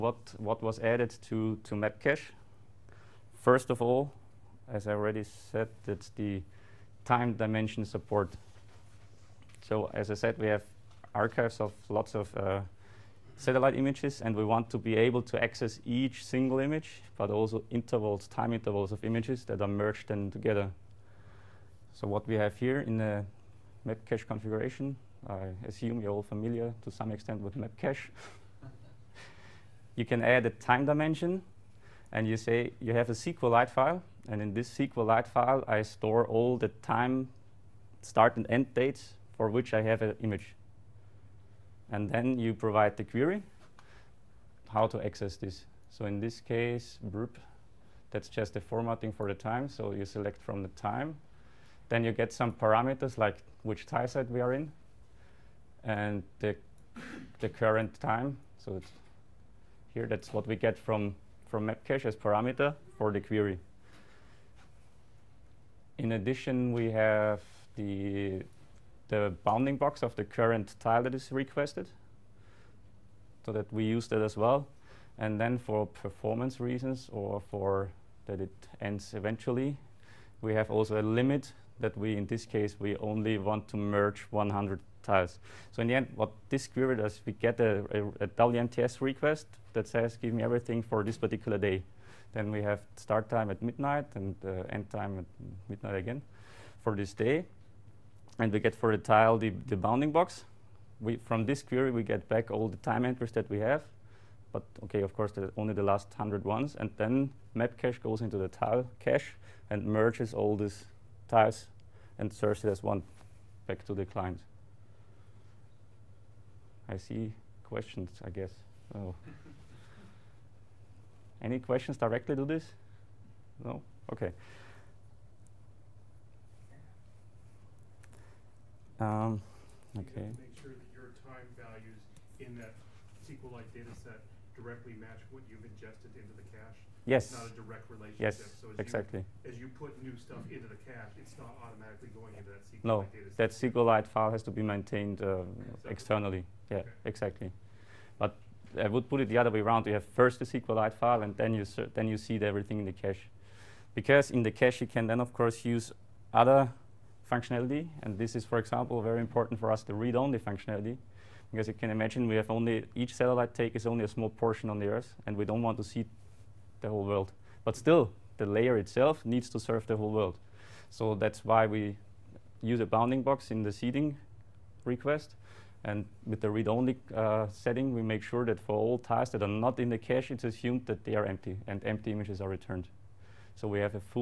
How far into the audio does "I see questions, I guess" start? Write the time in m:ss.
1:56.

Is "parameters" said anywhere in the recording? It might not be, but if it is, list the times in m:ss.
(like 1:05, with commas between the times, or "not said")
0:52, 1:02.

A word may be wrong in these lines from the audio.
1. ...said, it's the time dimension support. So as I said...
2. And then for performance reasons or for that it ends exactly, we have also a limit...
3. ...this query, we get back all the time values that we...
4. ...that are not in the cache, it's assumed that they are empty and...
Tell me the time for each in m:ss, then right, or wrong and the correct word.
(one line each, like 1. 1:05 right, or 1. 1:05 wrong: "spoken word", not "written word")
1. 0:05 right
2. 1:15 wrong: "eventually", not "exactly"
3. 1:41 wrong: "entries", not "values"
4. 2:59 right.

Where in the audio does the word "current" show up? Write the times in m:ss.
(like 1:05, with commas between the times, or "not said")
0:57, 1:10.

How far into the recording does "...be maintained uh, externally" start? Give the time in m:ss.
2:24.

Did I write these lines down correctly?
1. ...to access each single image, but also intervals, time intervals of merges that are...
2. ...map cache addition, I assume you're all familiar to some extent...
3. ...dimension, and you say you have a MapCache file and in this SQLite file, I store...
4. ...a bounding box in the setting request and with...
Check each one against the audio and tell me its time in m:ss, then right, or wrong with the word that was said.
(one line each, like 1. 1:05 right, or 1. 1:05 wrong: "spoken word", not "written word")
1. 0:15 wrong: "images", not "merges"
2. 0:23 wrong: "configuration", not "addition"
3. 0:30 wrong: "SQLite", not "MapCache"
4. 2:52 wrong: "seeding", not "setting".